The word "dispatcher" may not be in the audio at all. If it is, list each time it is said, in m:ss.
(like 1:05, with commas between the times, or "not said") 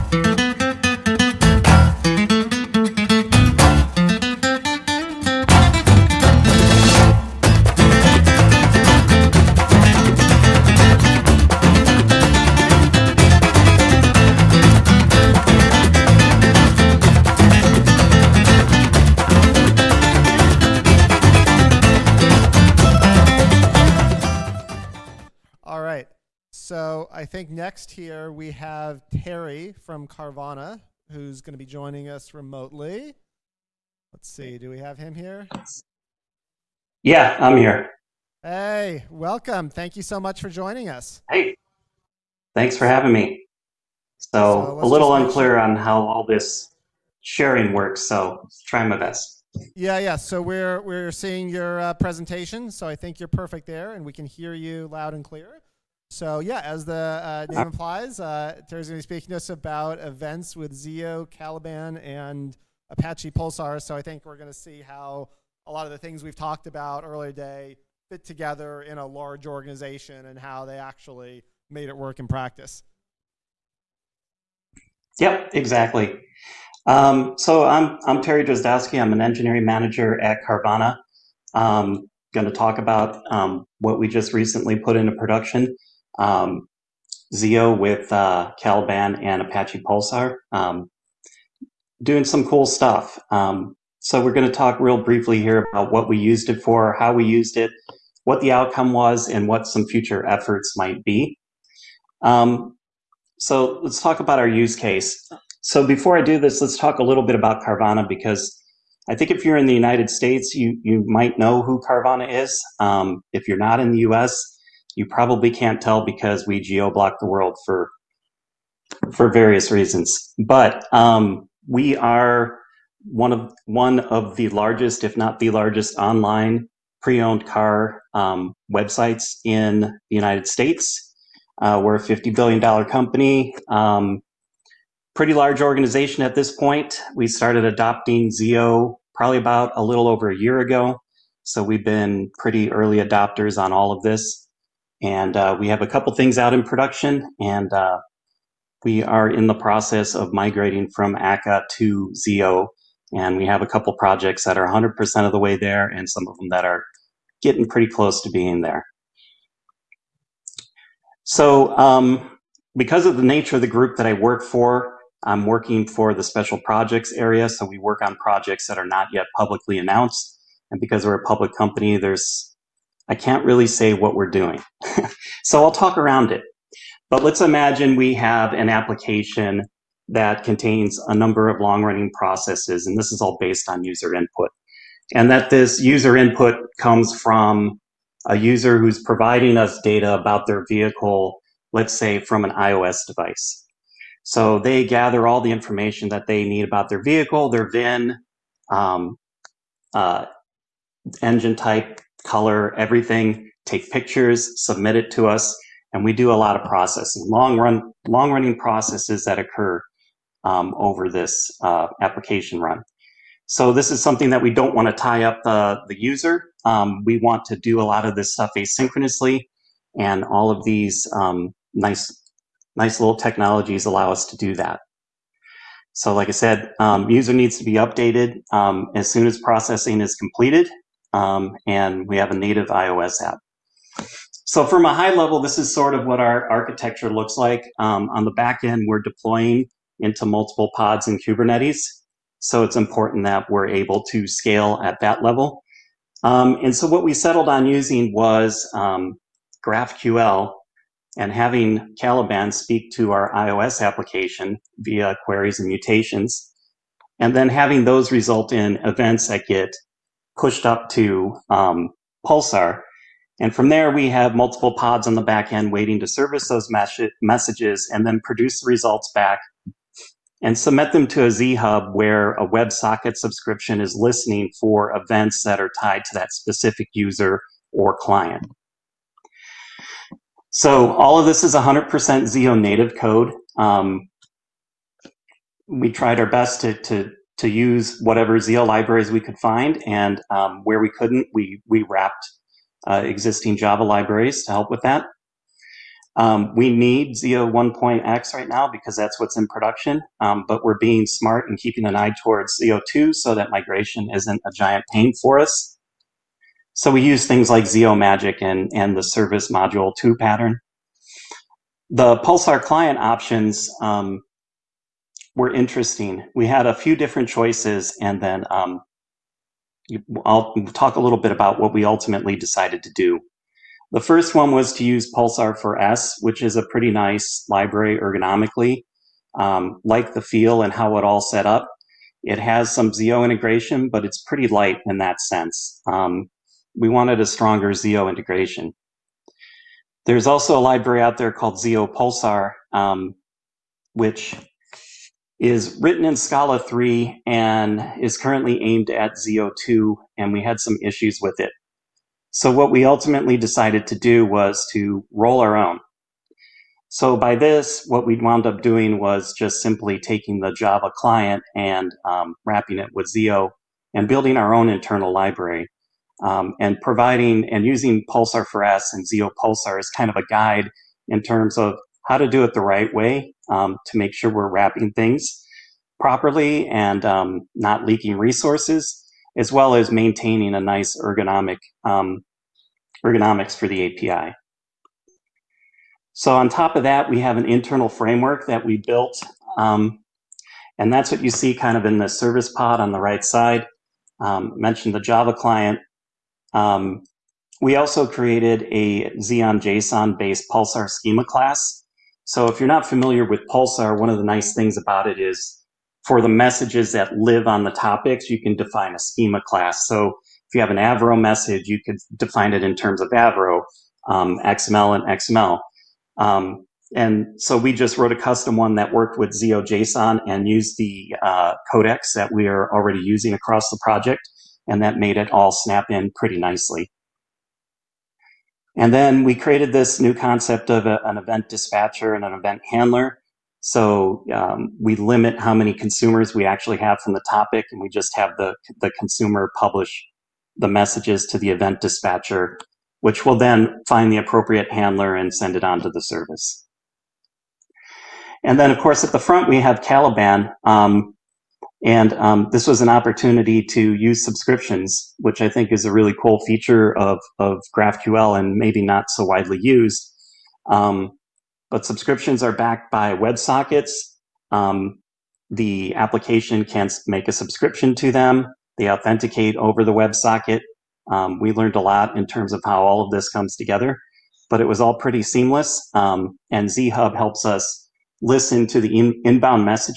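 7:11, 7:21.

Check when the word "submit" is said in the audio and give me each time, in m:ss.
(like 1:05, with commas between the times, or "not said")
3:24, 4:30.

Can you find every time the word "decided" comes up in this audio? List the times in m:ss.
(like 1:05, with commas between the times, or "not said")
5:22, 5:53.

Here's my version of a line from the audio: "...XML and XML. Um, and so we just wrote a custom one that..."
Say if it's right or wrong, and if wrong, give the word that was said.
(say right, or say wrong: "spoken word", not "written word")
right.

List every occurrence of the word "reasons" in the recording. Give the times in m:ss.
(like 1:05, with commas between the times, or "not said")
1:59.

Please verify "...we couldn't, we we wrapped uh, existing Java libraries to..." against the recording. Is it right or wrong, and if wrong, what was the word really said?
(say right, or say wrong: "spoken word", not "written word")
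right.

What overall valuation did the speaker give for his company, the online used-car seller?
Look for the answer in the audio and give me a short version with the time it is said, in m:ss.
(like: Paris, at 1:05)
$50 billion, at 2:12.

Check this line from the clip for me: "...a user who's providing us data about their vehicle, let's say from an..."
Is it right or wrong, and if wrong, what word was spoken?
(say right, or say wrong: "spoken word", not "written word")
right.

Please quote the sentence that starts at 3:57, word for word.
Um, on the back end, we're deploying into multiple pods in Kubernetes.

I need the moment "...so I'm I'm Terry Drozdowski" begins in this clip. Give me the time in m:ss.
1:17.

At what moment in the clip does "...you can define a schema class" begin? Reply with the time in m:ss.
6:48.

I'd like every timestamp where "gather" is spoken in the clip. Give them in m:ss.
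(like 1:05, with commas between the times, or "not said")
3:14.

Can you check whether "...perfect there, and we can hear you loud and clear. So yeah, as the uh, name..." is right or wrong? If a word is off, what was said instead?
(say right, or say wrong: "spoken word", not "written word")
right.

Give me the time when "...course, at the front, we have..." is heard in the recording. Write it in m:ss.
7:28.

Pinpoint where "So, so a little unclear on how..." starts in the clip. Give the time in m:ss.
0:44.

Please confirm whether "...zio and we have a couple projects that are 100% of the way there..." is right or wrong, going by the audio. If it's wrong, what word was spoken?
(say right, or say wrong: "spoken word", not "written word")
right.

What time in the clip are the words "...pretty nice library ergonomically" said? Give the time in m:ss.
5:26.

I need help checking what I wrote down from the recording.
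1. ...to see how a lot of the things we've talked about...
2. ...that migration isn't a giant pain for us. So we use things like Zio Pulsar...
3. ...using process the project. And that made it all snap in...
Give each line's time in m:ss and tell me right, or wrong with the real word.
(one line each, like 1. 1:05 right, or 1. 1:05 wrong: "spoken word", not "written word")
1. 1:04 right
2. 5:03 wrong: "Magic", not "Pulsar"
3. 7:03 wrong: "across", not "process".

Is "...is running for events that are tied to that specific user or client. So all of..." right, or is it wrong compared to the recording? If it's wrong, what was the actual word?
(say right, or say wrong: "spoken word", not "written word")
wrong: "listening", not "running".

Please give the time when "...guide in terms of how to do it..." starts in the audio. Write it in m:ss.
6:10.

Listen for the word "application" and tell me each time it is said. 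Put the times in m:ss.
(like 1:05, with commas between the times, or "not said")
2:58, 3:32, 4:13, 7:45.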